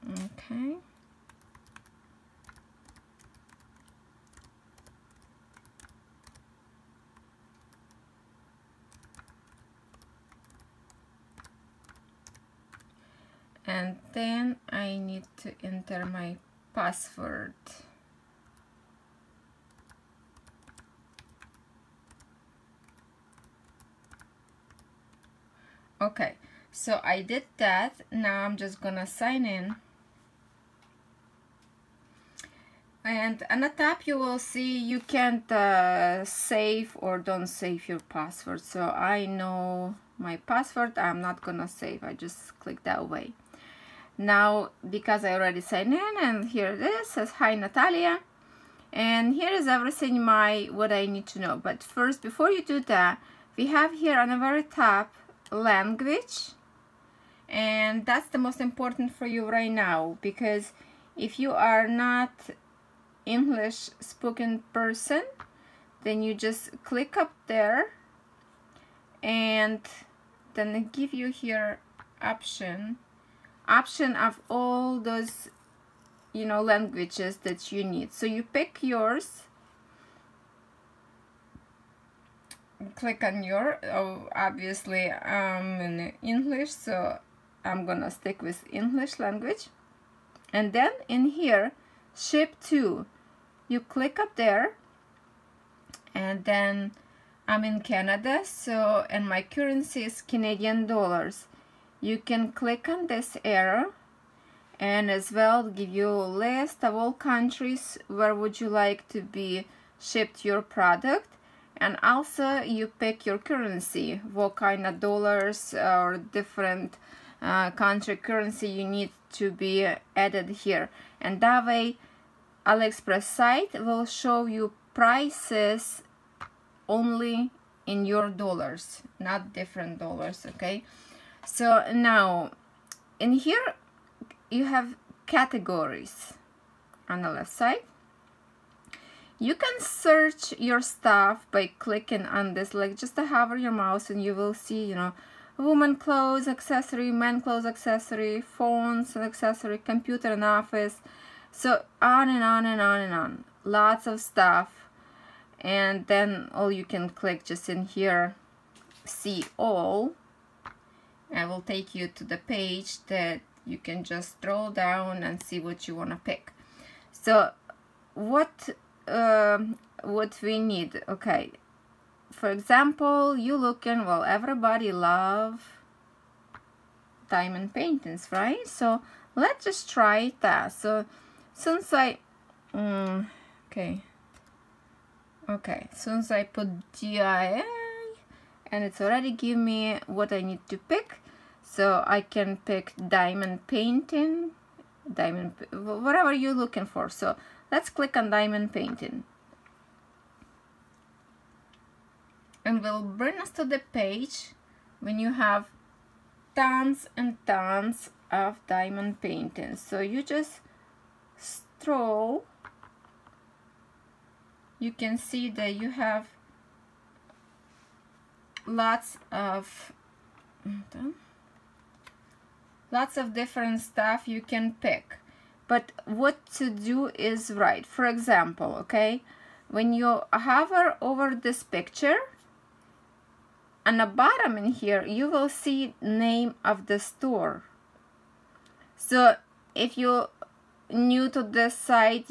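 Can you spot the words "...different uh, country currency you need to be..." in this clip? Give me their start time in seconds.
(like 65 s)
116 s.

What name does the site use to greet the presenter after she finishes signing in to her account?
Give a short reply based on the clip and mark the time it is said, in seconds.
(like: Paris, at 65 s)
Natalia, at 47 s.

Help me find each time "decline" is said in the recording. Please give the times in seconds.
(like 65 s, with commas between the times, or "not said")
not said.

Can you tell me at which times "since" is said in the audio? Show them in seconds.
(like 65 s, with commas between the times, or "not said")
181 s, 185 s.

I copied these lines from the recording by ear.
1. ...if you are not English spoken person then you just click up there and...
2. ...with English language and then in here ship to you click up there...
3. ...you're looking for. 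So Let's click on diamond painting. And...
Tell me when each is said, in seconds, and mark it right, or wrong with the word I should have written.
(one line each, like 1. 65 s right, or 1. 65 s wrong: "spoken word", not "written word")
1. 61 s right
2. 88 s right
3. 196 s right.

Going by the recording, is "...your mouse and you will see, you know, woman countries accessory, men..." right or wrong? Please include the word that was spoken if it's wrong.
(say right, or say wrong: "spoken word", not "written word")
wrong: "clothes", not "countries".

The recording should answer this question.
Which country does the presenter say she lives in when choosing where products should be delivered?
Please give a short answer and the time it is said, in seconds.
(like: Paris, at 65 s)
Canada, at 97 s.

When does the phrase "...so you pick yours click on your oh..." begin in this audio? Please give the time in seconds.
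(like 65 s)
78 s.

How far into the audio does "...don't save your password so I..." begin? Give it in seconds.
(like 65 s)
37 s.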